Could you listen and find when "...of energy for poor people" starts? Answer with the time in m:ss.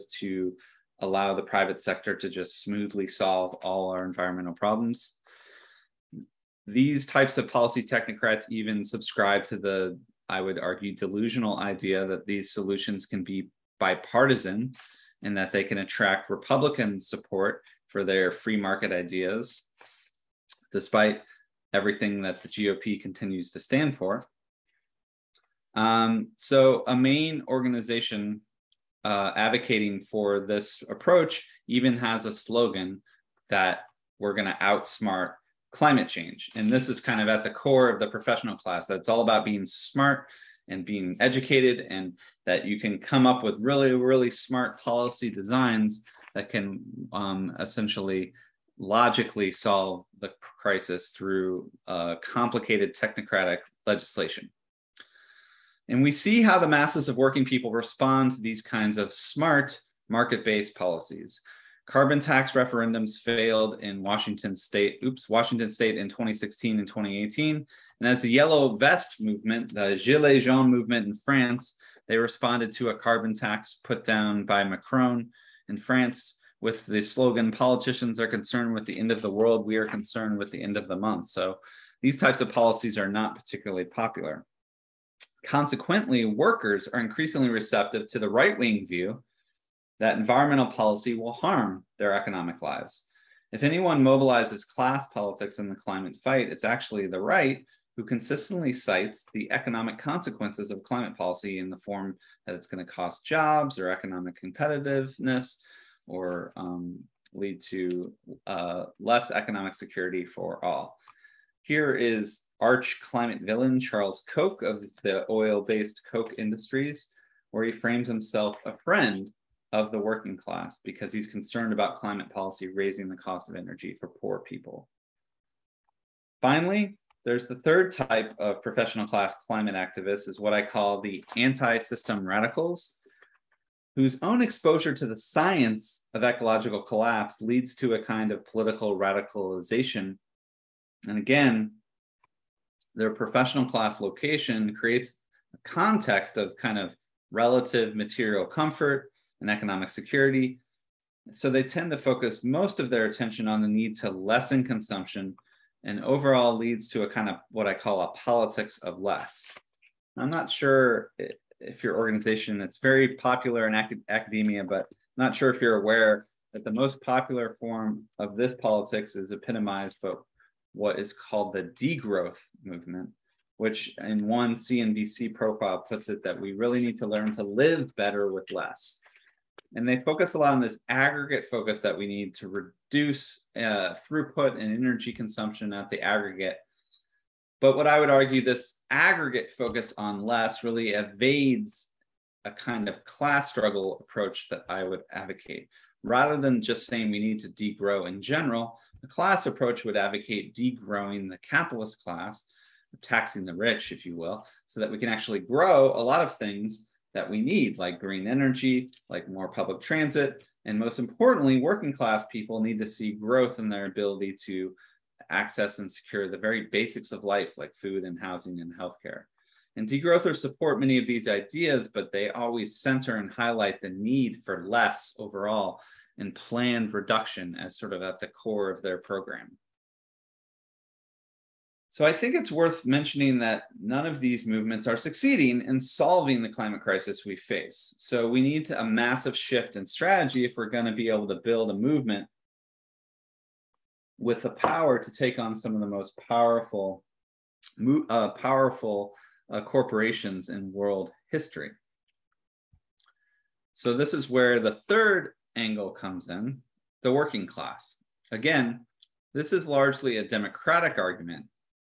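2:03.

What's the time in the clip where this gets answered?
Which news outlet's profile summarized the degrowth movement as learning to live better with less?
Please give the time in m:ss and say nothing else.
2:54.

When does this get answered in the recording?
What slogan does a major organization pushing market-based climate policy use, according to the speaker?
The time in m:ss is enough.
0:34.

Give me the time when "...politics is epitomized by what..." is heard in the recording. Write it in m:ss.
2:48.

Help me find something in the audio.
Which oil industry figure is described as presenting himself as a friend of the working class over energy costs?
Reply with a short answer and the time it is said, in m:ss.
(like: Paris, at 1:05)
Charles Koch, at 1:53.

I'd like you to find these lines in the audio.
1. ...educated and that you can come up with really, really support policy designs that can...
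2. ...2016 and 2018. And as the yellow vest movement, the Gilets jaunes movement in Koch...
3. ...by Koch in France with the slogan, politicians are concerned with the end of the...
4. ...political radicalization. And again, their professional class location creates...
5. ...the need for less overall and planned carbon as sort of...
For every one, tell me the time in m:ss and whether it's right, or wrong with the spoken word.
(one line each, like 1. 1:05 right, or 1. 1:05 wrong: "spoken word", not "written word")
1. 0:41 wrong: "smart", not "support"
2. 1:06 wrong: "France", not "Koch"
3. 1:14 wrong: "Macron", not "Koch"
4. 2:18 right
5. 3:43 wrong: "reduction", not "carbon".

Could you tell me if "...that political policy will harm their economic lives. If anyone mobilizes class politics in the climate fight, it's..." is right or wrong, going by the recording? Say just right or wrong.
wrong.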